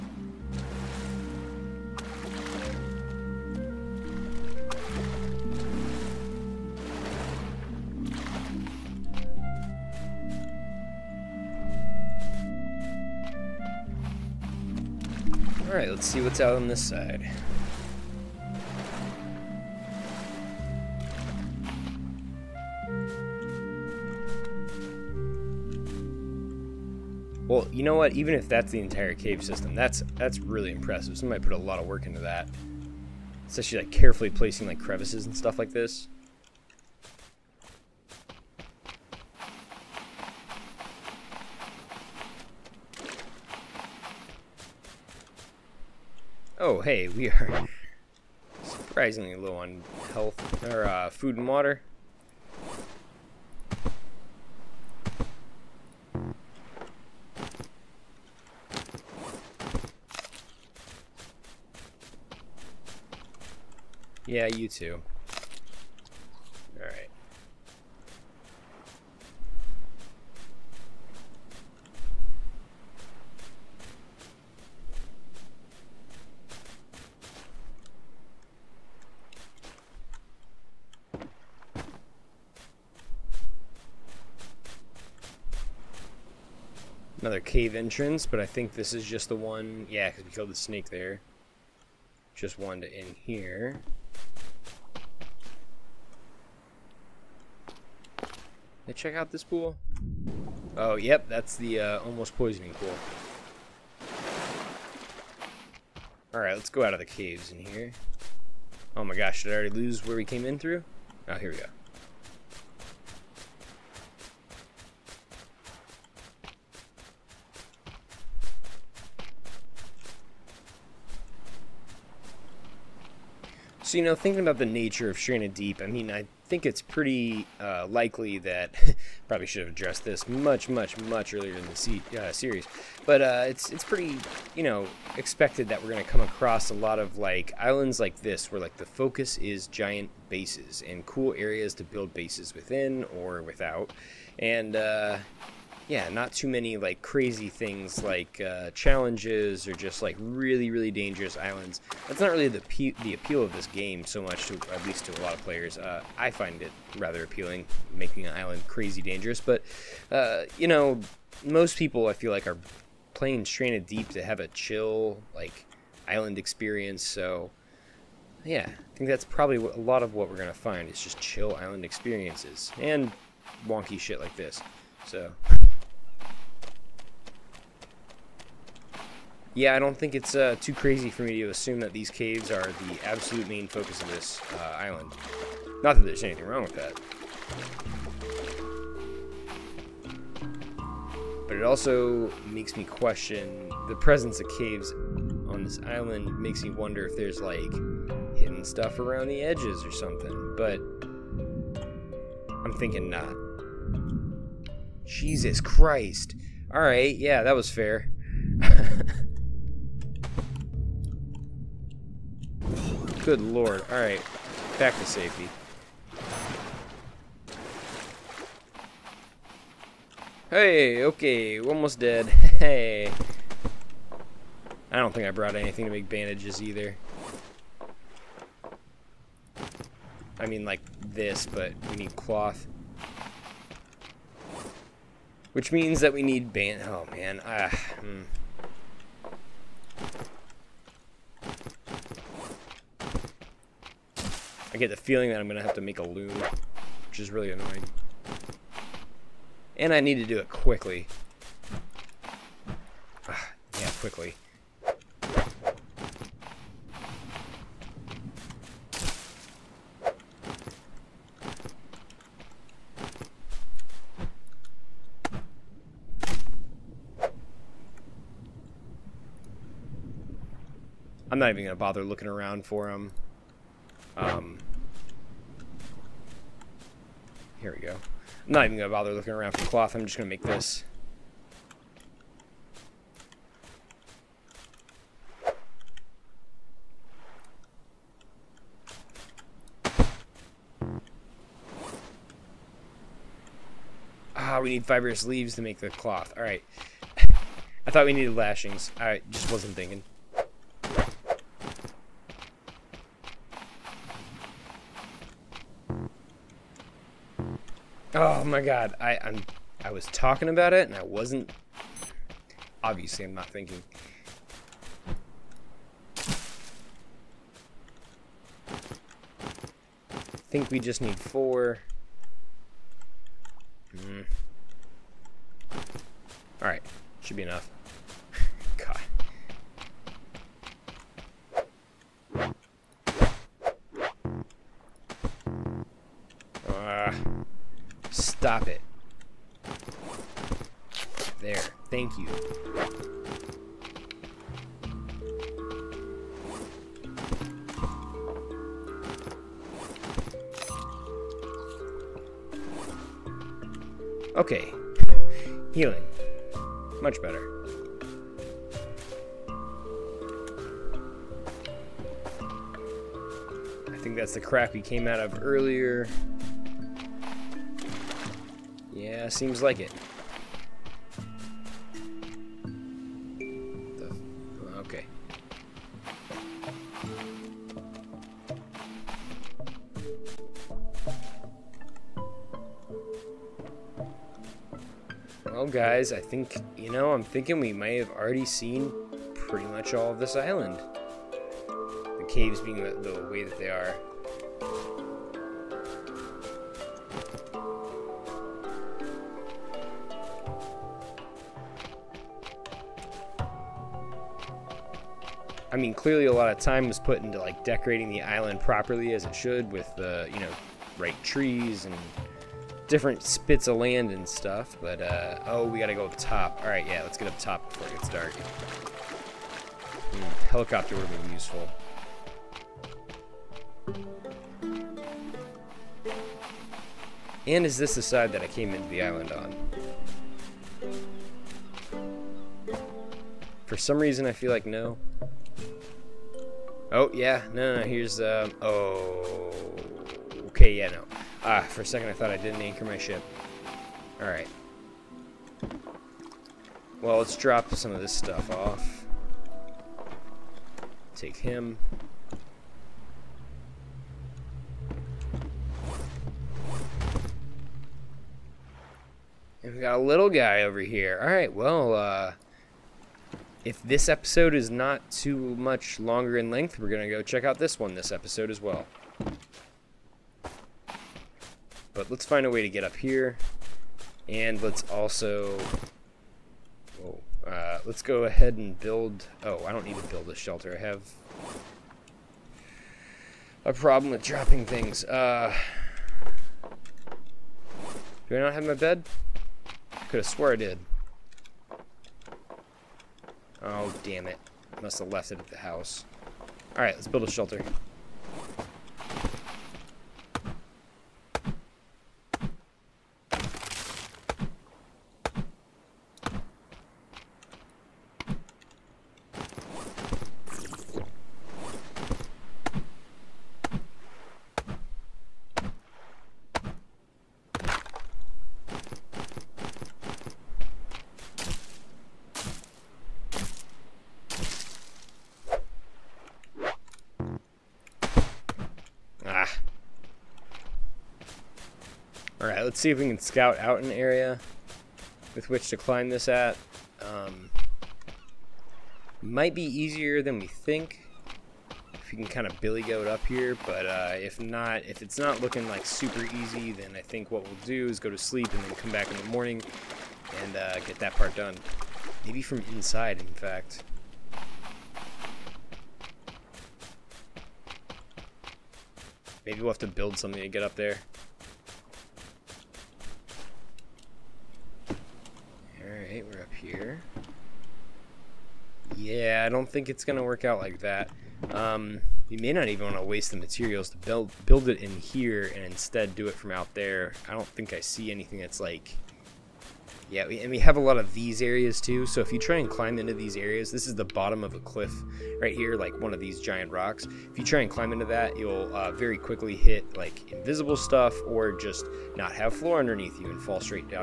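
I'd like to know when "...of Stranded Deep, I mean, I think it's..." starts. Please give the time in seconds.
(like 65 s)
125 s.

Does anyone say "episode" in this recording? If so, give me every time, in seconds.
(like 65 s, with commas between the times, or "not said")
464 s, 468 s.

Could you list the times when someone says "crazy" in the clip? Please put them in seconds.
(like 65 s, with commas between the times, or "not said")
147 s, 158 s, 180 s.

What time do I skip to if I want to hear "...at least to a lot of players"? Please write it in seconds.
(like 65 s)
154 s.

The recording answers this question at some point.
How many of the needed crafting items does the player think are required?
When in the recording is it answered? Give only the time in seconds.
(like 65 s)
321 s.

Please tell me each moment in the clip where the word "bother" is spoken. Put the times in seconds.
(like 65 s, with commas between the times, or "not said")
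271 s, 278 s.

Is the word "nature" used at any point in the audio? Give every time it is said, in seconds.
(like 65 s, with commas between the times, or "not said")
124 s.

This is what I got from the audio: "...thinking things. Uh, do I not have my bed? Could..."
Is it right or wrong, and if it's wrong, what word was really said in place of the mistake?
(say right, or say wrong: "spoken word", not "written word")
wrong: "dropping", not "thinking".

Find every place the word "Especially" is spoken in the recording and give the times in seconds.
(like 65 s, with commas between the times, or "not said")
33 s.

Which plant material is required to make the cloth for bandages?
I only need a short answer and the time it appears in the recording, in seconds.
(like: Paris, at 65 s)
Fibrous leaves, at 294 s.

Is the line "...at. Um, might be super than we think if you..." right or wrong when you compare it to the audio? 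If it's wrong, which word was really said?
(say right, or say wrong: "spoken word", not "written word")
wrong: "easier", not "super".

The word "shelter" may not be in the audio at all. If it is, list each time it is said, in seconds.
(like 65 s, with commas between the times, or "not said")
480 s, 497 s.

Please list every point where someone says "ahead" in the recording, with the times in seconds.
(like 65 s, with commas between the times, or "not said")
478 s.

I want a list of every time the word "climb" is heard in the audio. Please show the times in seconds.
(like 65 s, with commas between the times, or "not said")
535 s, 582 s, 587 s.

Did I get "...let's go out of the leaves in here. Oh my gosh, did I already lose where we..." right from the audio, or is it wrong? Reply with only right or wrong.
wrong.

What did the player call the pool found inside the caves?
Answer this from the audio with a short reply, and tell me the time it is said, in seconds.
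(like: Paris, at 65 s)
Almost poisoning pool, at 102 s.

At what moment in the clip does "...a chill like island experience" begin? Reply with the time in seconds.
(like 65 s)
164 s.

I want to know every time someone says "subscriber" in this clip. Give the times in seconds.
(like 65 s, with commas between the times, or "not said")
not said.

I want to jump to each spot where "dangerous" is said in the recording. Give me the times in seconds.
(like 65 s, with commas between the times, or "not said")
150 s, 159 s.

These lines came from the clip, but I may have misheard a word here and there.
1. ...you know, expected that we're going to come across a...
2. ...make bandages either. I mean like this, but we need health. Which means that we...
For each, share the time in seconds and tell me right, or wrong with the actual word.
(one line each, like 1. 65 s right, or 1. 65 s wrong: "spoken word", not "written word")
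1. 134 s right
2. 225 s wrong: "cloth", not "health".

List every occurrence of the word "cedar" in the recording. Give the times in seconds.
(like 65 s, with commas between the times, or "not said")
not said.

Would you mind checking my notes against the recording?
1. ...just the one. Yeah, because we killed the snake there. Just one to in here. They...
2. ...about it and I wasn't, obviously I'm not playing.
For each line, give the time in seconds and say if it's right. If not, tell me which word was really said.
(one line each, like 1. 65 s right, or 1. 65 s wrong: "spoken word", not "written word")
1. 89 s right
2. 310 s wrong: "thinking", not "playing".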